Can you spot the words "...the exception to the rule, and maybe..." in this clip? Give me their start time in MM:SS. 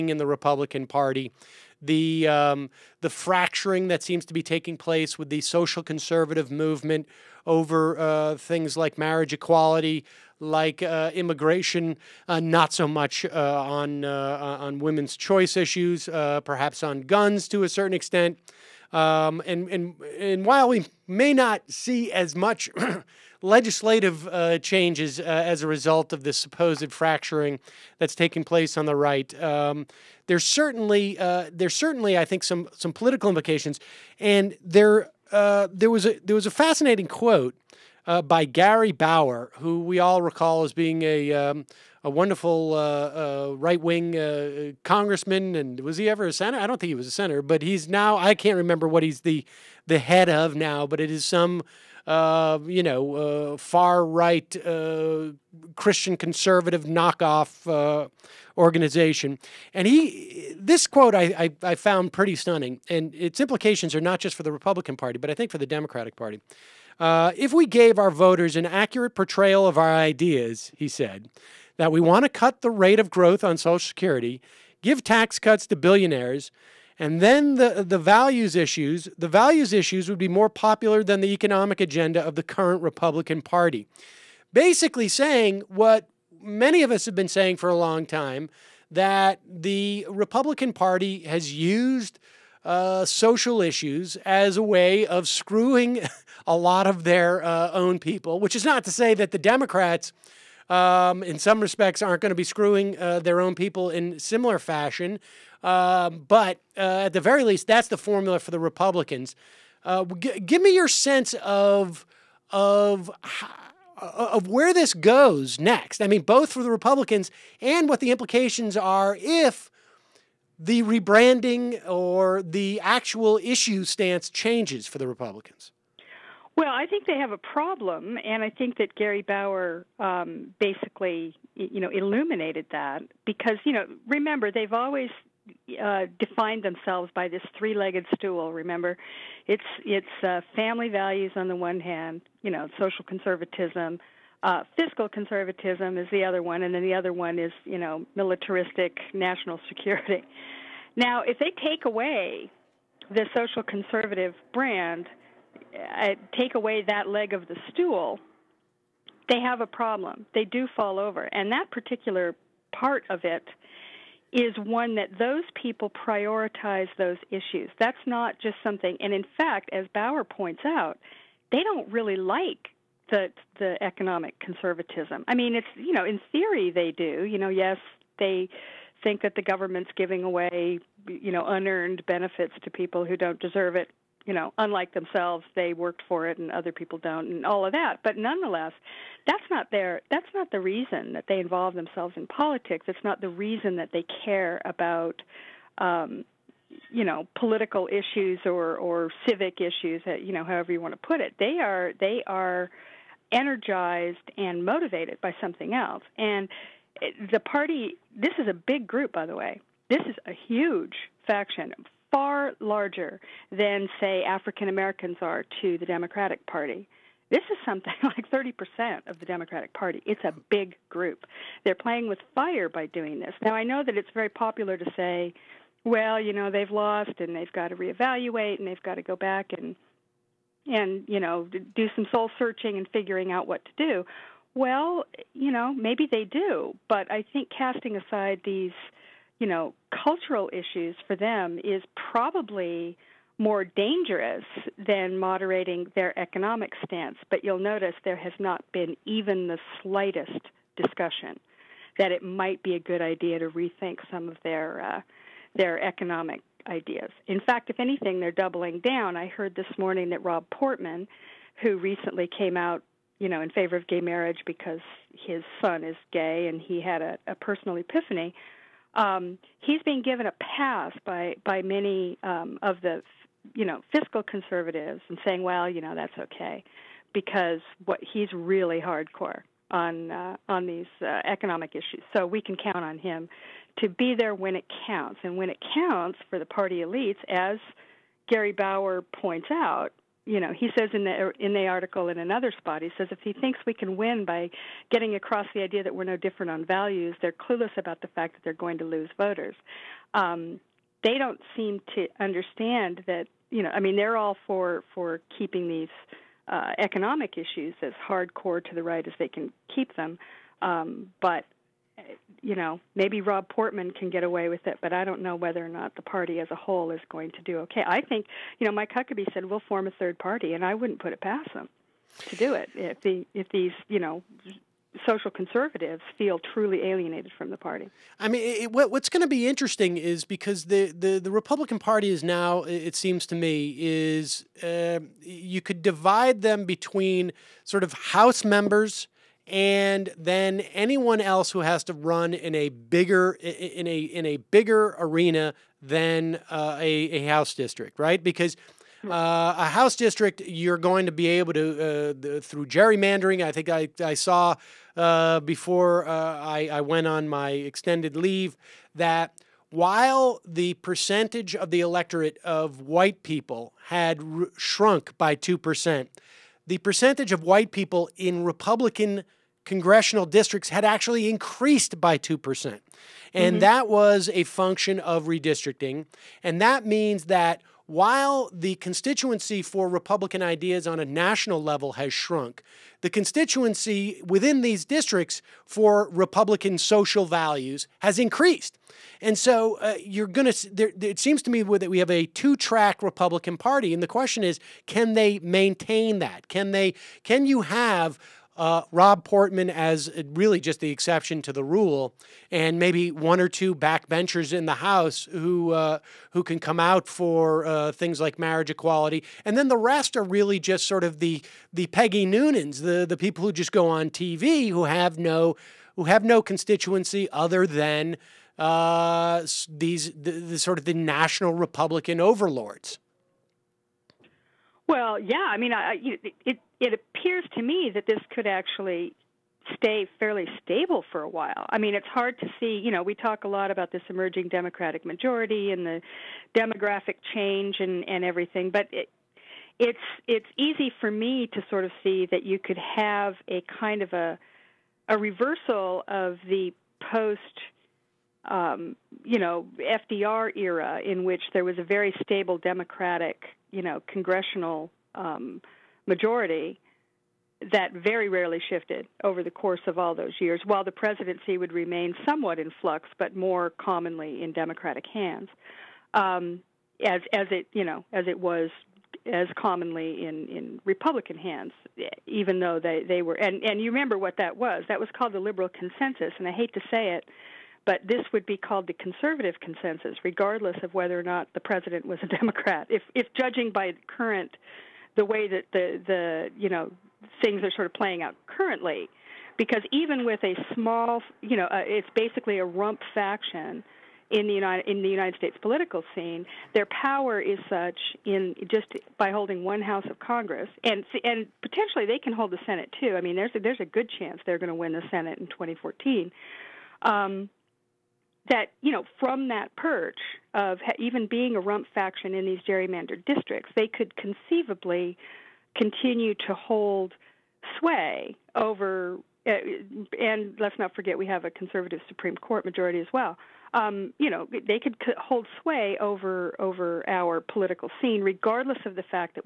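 06:40.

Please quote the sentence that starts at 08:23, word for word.
I mean, there's a, there's a good chance they're going to win the Senate in 2014.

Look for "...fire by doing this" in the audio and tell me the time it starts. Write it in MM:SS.
03:42.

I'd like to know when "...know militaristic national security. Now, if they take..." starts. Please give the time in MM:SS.
02:27.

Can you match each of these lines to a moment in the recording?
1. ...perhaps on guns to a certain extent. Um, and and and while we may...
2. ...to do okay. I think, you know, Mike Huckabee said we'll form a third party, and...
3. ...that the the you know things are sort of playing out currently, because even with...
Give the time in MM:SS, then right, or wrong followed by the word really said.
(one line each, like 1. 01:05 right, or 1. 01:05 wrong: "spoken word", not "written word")
1. 00:16 right
2. 05:17 right
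3. 08:05 right.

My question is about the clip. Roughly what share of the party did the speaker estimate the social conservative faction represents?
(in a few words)
30%.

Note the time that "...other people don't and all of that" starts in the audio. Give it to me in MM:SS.
03:06.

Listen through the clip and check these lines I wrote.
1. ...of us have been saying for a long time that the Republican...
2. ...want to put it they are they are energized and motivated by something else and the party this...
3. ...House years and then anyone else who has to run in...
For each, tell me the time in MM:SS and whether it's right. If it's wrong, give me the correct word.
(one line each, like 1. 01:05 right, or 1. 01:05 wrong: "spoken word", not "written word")
1. 01:26 right
2. 03:20 right
3. 05:37 wrong: "members", not "years".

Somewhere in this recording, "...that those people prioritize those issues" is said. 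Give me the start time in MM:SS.
02:44.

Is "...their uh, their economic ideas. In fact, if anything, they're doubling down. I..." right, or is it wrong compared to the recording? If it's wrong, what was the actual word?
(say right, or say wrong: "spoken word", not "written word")
right.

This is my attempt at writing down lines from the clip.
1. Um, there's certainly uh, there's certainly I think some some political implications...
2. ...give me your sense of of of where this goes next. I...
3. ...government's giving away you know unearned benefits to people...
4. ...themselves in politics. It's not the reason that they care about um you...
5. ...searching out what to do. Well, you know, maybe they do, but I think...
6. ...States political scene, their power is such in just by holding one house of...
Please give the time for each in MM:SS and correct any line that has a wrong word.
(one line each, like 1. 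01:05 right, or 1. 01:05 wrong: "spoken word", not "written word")
1. 00:29 right
2. 01:50 right
3. 02:59 right
4. 03:11 right
5. 03:52 wrong: "figuring", not "searching"
6. 08:15 right.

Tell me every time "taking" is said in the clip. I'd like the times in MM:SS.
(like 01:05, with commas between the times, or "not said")
00:04, 00:28.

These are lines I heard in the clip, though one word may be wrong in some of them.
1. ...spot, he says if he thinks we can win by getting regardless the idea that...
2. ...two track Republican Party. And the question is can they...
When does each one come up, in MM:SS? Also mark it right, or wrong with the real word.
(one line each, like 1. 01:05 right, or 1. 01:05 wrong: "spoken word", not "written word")
1. 04:52 wrong: "across", not "regardless"
2. 06:32 right.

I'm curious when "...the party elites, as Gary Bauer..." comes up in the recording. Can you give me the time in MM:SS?
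04:46.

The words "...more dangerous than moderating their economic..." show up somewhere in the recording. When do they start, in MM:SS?
04:03.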